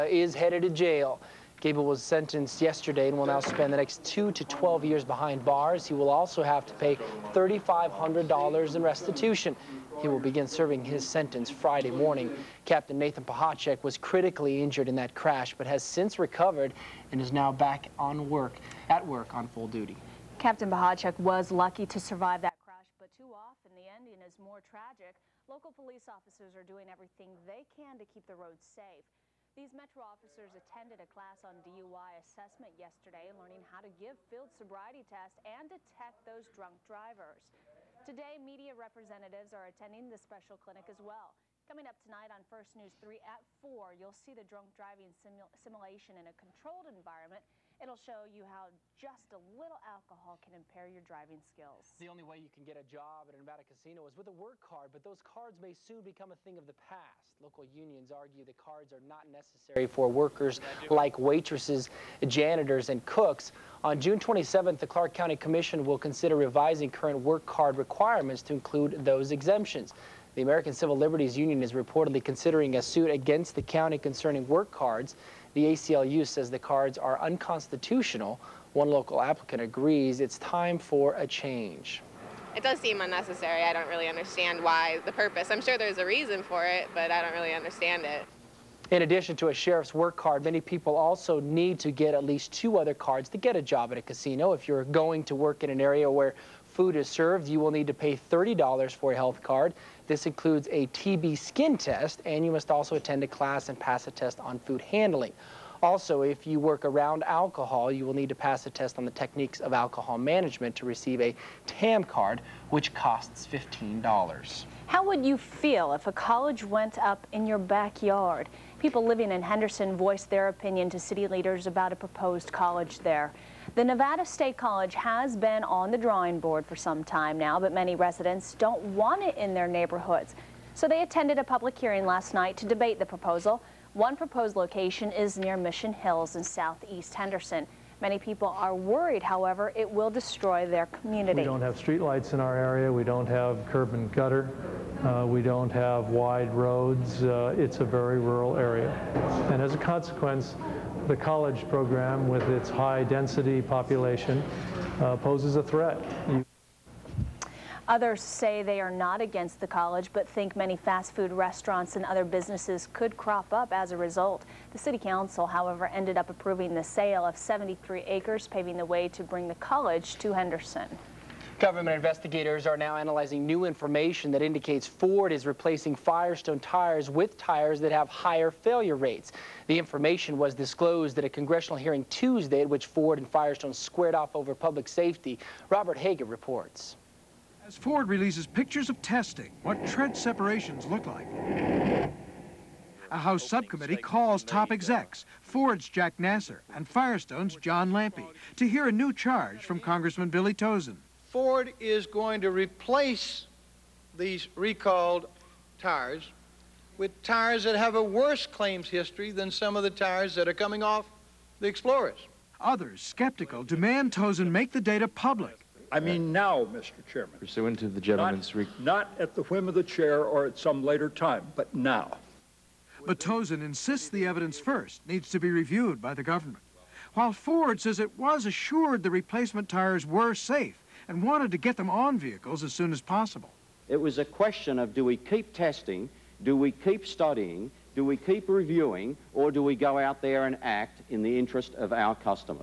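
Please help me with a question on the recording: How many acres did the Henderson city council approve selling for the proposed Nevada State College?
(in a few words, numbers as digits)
73.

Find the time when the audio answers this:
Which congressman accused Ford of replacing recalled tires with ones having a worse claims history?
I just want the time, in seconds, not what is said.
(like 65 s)
200 s.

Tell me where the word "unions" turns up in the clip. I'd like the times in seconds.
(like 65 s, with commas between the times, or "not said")
57 s, 71 s.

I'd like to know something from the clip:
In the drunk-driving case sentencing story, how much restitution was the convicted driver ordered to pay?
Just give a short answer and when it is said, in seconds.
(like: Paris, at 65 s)
$3,500, at 7 s.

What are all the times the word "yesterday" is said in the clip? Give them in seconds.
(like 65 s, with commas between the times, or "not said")
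2 s, 32 s.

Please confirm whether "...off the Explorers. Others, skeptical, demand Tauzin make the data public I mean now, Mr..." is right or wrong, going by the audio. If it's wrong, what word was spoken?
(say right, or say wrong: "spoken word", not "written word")
right.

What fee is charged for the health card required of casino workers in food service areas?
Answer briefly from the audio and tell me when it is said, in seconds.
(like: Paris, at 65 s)
$30, at 98 s.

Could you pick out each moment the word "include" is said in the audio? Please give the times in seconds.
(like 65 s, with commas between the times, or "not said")
68 s, 100 s.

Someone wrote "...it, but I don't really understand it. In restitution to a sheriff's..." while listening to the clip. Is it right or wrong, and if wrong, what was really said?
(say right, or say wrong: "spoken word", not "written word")
wrong: "addition", not "restitution".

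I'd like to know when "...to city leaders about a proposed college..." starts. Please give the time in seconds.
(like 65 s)
120 s.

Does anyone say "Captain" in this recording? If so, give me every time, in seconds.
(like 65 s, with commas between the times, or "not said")
12 s, 20 s.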